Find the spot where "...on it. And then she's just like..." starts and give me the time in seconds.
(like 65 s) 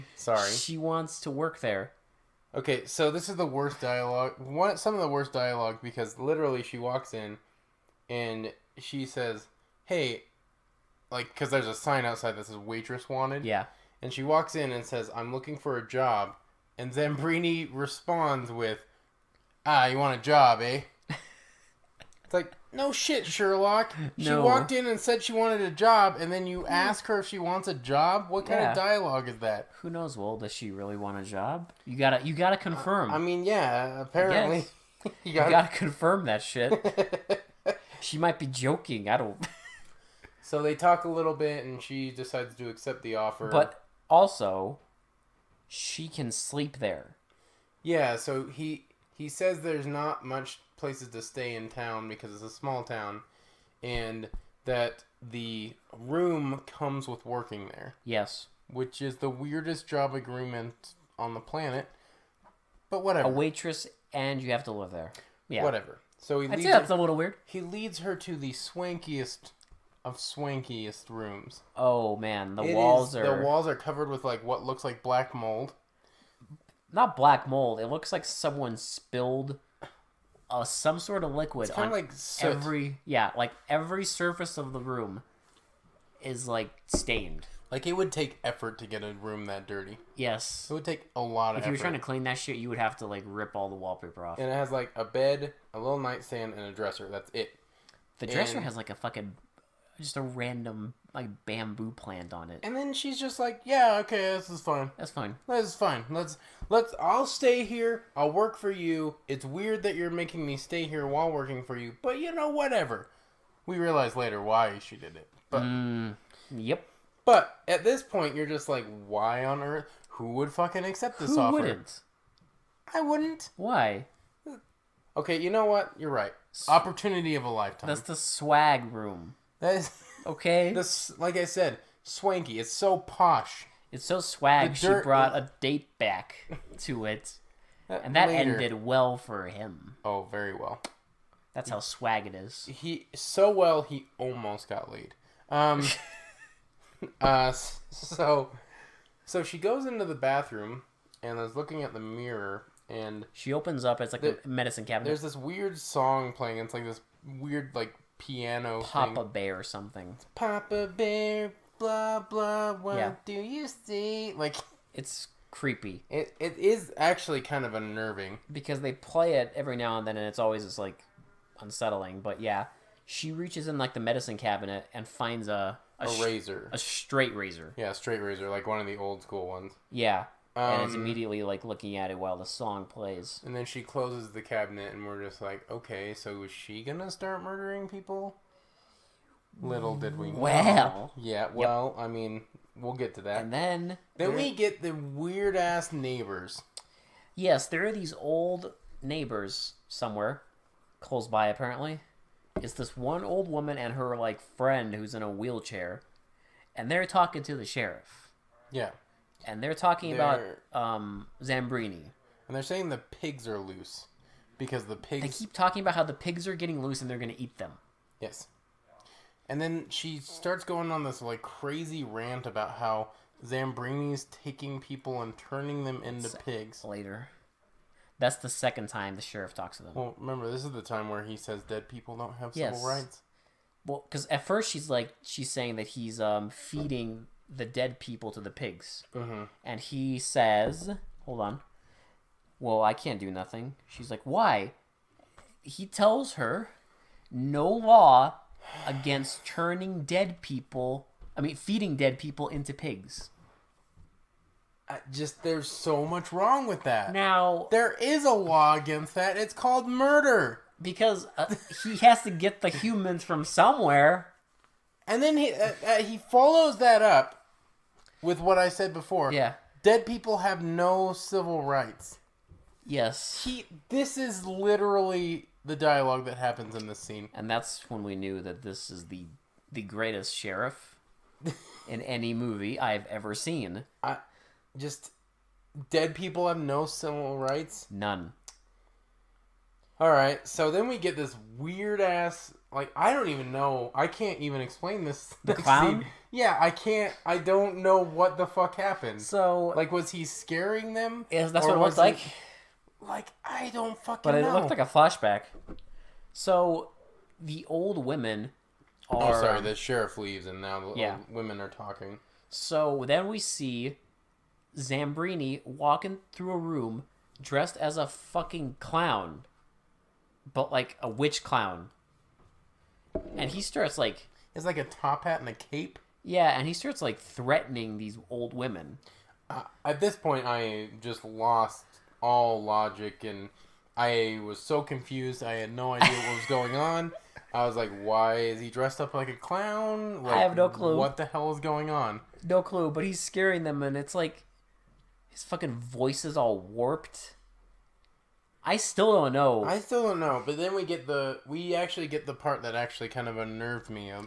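102 s.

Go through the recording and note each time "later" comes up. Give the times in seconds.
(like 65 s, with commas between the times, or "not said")
114 s, 138 s, 226 s.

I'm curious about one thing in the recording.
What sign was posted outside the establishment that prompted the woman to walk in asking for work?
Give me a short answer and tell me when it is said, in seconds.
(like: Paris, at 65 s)
Waitress wanted, at 12 s.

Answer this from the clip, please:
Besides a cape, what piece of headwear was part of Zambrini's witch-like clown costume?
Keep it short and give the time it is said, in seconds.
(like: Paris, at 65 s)
A top hat, at 324 s.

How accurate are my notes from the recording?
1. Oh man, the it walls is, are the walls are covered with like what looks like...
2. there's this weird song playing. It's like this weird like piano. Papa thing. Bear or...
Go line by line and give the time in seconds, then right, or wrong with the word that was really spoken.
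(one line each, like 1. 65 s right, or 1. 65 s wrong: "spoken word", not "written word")
1. 71 s right
2. 155 s right.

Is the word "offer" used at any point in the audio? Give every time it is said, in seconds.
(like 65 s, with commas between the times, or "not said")
43 s, 121 s.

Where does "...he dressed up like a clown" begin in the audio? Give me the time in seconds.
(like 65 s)
338 s.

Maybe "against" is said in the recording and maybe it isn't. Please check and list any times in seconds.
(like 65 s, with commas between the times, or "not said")
248 s, 258 s.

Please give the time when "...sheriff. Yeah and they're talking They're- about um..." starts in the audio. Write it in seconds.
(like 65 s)
207 s.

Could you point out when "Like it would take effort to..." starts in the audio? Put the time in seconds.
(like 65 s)
87 s.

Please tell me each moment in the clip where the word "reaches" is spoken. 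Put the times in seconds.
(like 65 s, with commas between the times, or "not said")
173 s.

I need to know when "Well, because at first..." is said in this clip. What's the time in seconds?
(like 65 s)
233 s.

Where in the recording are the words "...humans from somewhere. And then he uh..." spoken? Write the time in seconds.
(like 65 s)
262 s.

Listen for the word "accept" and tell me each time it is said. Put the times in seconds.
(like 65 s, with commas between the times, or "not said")
42 s, 120 s.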